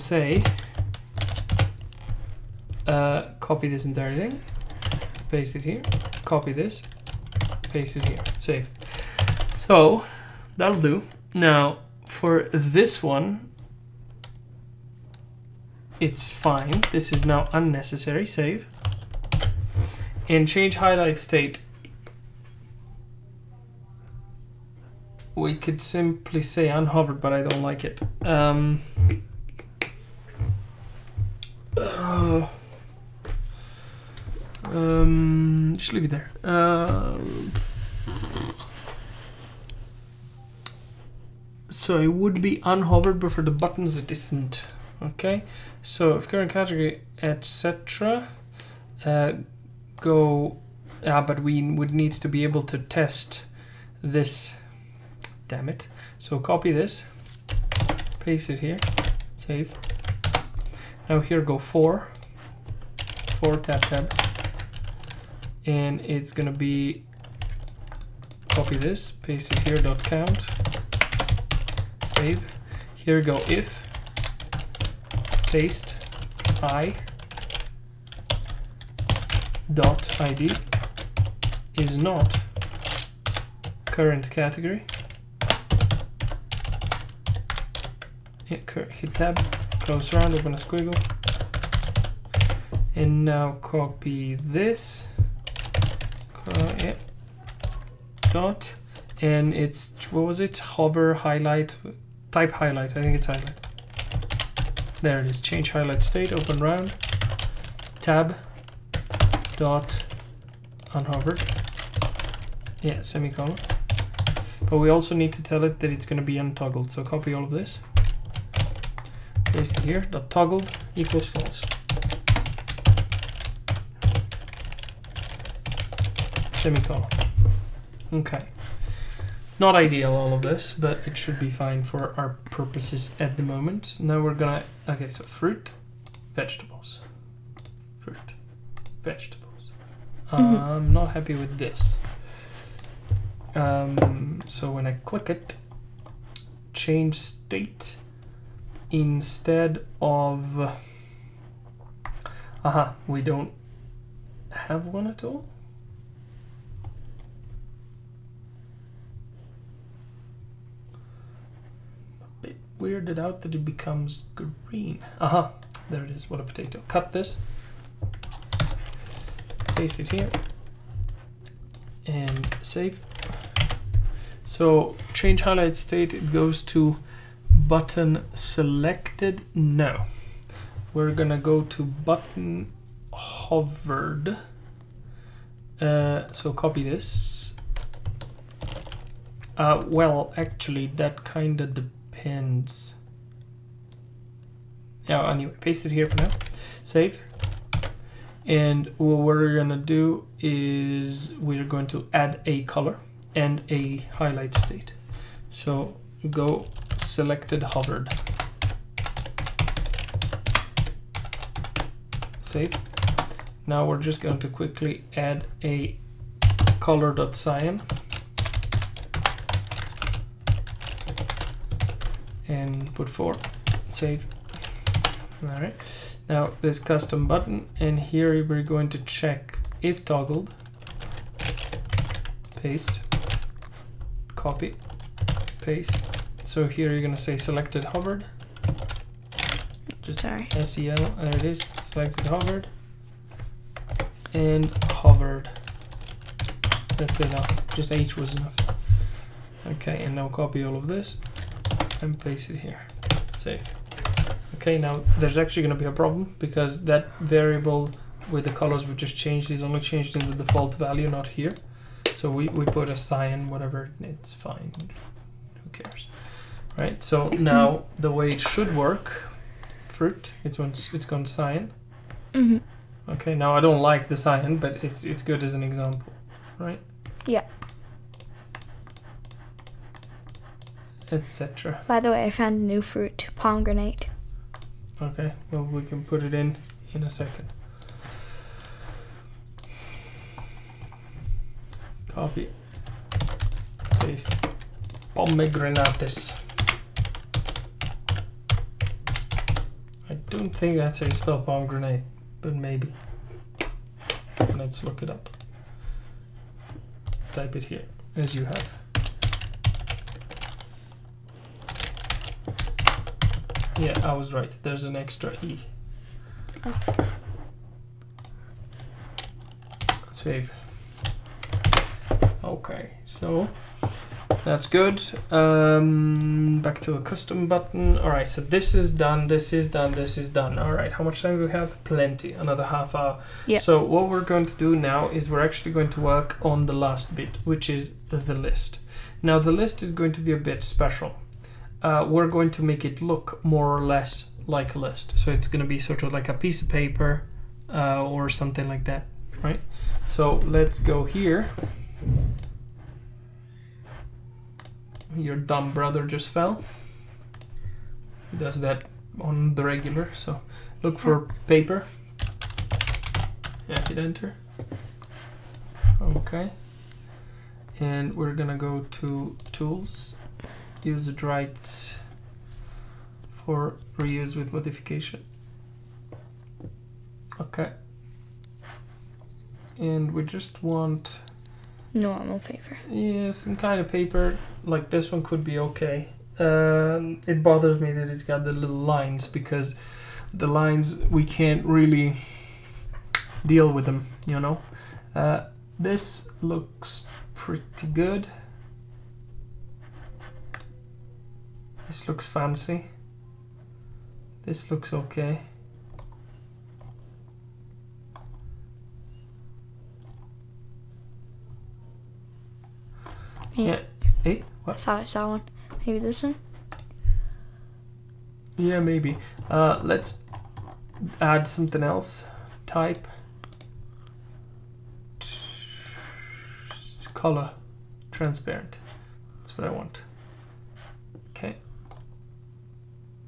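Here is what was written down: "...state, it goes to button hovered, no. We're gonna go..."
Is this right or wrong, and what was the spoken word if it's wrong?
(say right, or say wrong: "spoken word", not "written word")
wrong: "selected", not "hovered".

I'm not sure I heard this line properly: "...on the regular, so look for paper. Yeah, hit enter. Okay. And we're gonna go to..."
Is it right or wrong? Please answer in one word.
right.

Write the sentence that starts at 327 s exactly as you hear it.
All right, so this is done, this is done, this is done.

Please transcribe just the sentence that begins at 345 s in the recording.
So it's going to be sort of like a piece of paper uh, or something like that, right?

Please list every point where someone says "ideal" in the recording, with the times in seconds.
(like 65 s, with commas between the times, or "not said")
129 s.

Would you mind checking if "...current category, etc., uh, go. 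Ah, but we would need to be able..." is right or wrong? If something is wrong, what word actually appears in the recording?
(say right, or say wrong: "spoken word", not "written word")
right.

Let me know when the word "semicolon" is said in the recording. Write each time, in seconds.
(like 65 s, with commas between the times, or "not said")
113 s, 126 s.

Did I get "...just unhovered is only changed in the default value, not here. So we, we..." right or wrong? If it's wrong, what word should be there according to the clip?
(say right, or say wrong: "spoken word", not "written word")
wrong: "changed", not "unhovered".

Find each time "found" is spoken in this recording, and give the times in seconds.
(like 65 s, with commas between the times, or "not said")
282 s.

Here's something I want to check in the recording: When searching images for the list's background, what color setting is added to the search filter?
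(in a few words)
transparent.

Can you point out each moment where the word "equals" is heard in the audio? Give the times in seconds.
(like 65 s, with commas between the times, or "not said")
120 s.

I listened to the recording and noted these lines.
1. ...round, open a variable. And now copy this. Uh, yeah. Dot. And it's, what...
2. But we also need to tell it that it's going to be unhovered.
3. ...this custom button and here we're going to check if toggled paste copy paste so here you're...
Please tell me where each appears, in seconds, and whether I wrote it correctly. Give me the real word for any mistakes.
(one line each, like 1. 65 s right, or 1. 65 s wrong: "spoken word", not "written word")
1. 90 s wrong: "squiggle", not "variable"
2. 114 s wrong: "untoggled", not "unhovered"
3. 226 s right.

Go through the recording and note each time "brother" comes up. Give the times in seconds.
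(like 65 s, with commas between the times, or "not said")
355 s.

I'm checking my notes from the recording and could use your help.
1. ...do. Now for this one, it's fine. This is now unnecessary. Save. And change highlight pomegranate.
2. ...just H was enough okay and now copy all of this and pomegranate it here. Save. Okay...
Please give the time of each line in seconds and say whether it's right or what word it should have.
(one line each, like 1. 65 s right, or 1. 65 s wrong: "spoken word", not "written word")
1. 10 s wrong: "state", not "pomegranate"
2. 247 s wrong: "paste", not "pomegranate".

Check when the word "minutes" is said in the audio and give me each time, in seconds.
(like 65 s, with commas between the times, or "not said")
not said.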